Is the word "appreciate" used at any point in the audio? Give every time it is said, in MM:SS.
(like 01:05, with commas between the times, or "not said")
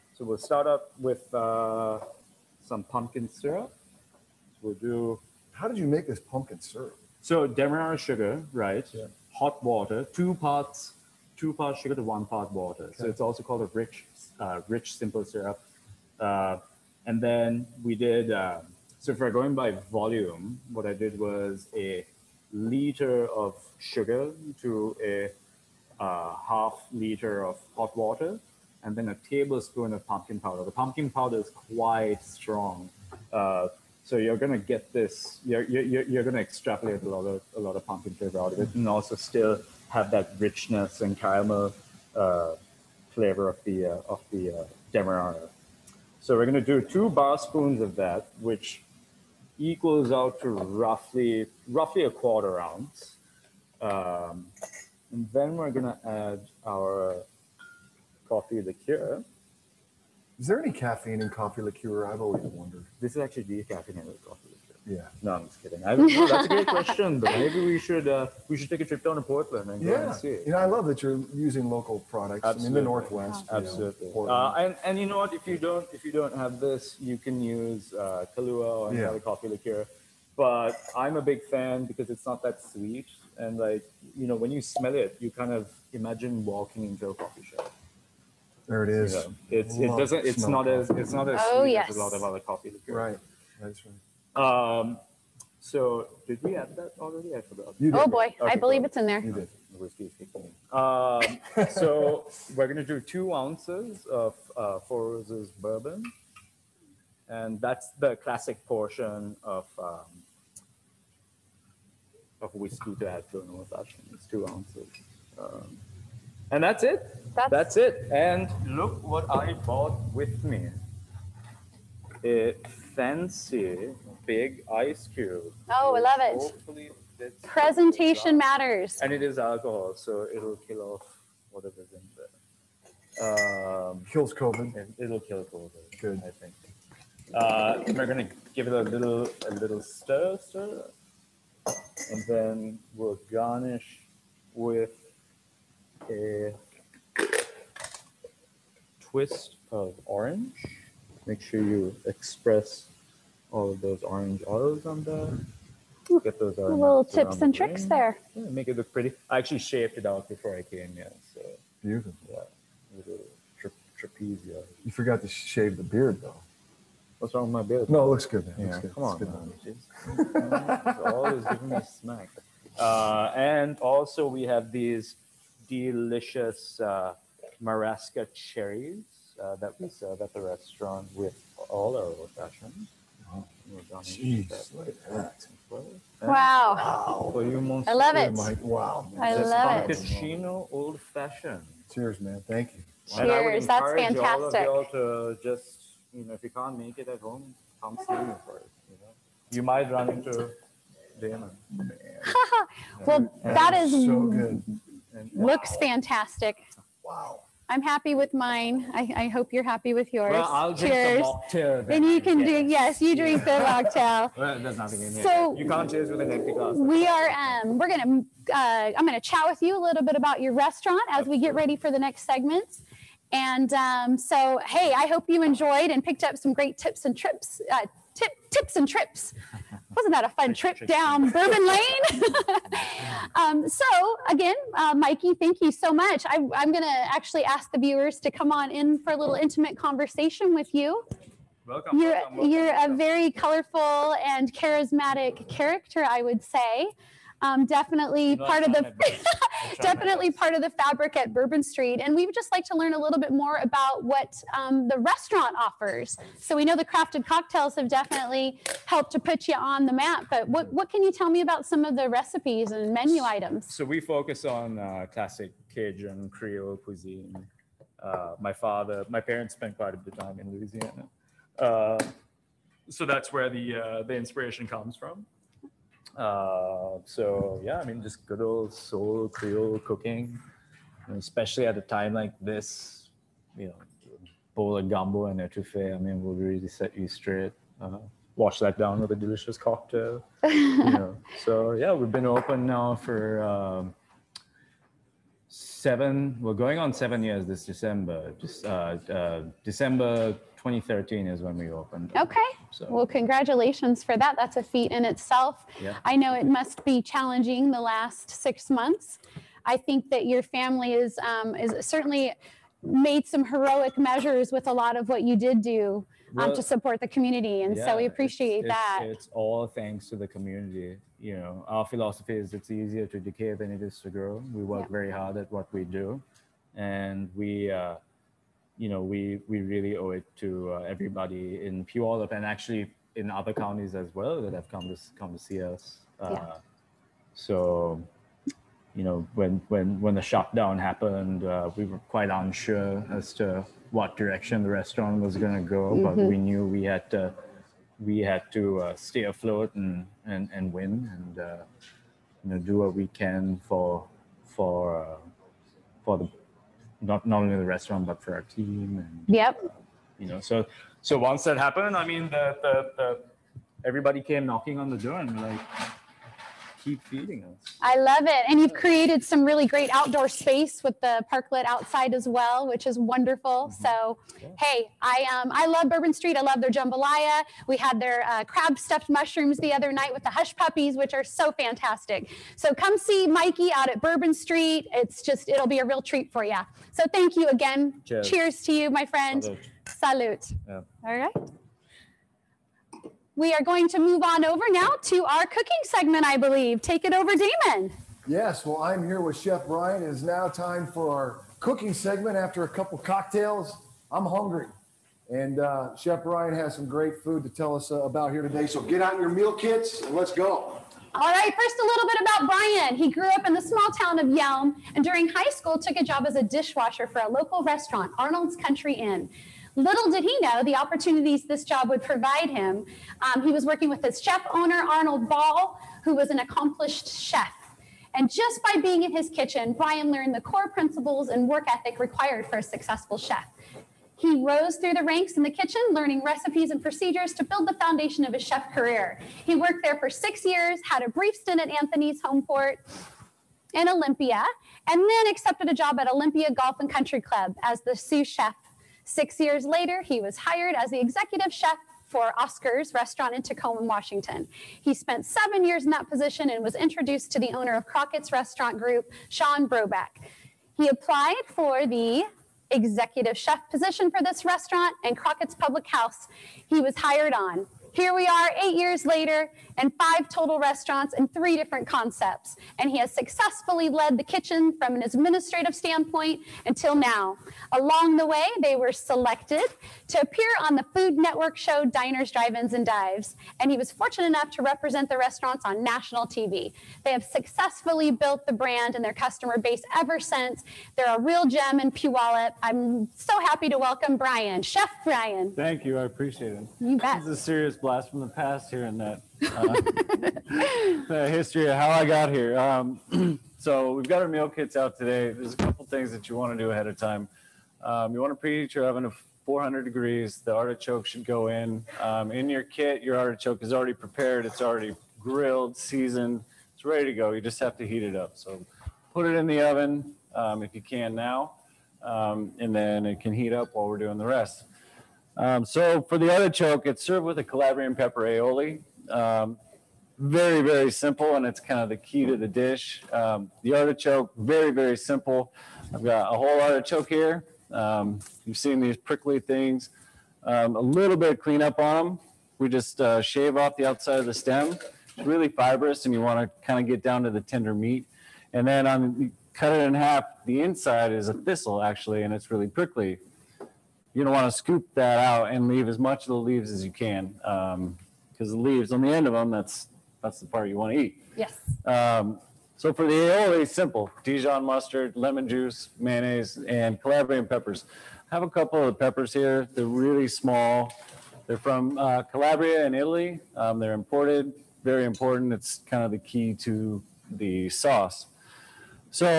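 05:18, 08:16.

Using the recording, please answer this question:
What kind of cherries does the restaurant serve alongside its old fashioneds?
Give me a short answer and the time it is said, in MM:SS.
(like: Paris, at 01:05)
Marasca cherries, at 02:57.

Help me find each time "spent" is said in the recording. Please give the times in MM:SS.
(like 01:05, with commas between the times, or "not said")
04:29, 07:34.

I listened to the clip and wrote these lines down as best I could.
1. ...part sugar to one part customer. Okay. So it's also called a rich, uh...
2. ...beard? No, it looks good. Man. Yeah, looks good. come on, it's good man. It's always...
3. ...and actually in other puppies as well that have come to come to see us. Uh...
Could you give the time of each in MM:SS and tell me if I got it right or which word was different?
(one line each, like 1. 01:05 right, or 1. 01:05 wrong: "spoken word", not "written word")
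1. 00:11 wrong: "water", not "customer"
2. 02:47 right
3. 05:32 wrong: "counties", not "puppies".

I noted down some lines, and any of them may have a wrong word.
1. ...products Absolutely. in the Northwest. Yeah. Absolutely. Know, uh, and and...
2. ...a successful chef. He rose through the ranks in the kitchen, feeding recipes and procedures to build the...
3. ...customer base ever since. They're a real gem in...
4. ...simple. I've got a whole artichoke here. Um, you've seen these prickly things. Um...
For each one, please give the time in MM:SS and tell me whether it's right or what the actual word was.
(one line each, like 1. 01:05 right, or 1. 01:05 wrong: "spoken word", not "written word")
1. 01:12 right
2. 07:12 wrong: "learning", not "feeding"
3. 08:09 right
4. 08:54 right.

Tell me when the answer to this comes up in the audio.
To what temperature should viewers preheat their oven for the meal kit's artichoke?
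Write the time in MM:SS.
08:29.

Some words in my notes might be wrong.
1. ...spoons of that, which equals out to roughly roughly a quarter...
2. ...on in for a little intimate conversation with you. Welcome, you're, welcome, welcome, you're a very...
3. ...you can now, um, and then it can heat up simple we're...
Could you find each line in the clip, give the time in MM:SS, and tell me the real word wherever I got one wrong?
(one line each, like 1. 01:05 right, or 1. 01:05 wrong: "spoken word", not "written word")
1. 00:47 right
2. 03:58 right
3. 08:40 wrong: "while", not "simple".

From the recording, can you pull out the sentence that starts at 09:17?
Um, because the leaves on the end of them, that's, that's the part you want to eat.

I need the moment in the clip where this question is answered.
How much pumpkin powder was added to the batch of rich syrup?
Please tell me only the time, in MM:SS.
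00:29.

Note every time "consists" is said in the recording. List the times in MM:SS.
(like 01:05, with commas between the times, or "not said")
not said.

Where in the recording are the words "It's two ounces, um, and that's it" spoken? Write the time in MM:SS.
01:54.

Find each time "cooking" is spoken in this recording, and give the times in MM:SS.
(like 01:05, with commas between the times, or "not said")
04:39, 06:35, 06:41.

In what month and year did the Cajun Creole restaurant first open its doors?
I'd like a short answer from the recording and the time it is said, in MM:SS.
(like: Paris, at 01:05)
December 2013, at 04:59.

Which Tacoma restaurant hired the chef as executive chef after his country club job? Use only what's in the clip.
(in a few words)
Oscar's.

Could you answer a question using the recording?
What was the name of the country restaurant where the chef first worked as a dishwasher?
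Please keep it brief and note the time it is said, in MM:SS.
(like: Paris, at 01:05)
Arnold's Country Inn, at 06:58.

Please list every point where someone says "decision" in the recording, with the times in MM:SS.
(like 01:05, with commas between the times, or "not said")
not said.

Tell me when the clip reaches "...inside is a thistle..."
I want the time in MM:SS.
09:10.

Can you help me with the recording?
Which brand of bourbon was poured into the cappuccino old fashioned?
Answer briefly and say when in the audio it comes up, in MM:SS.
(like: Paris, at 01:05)
Four Roses, at 01:44.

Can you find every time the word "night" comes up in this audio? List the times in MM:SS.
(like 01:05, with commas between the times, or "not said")
06:19.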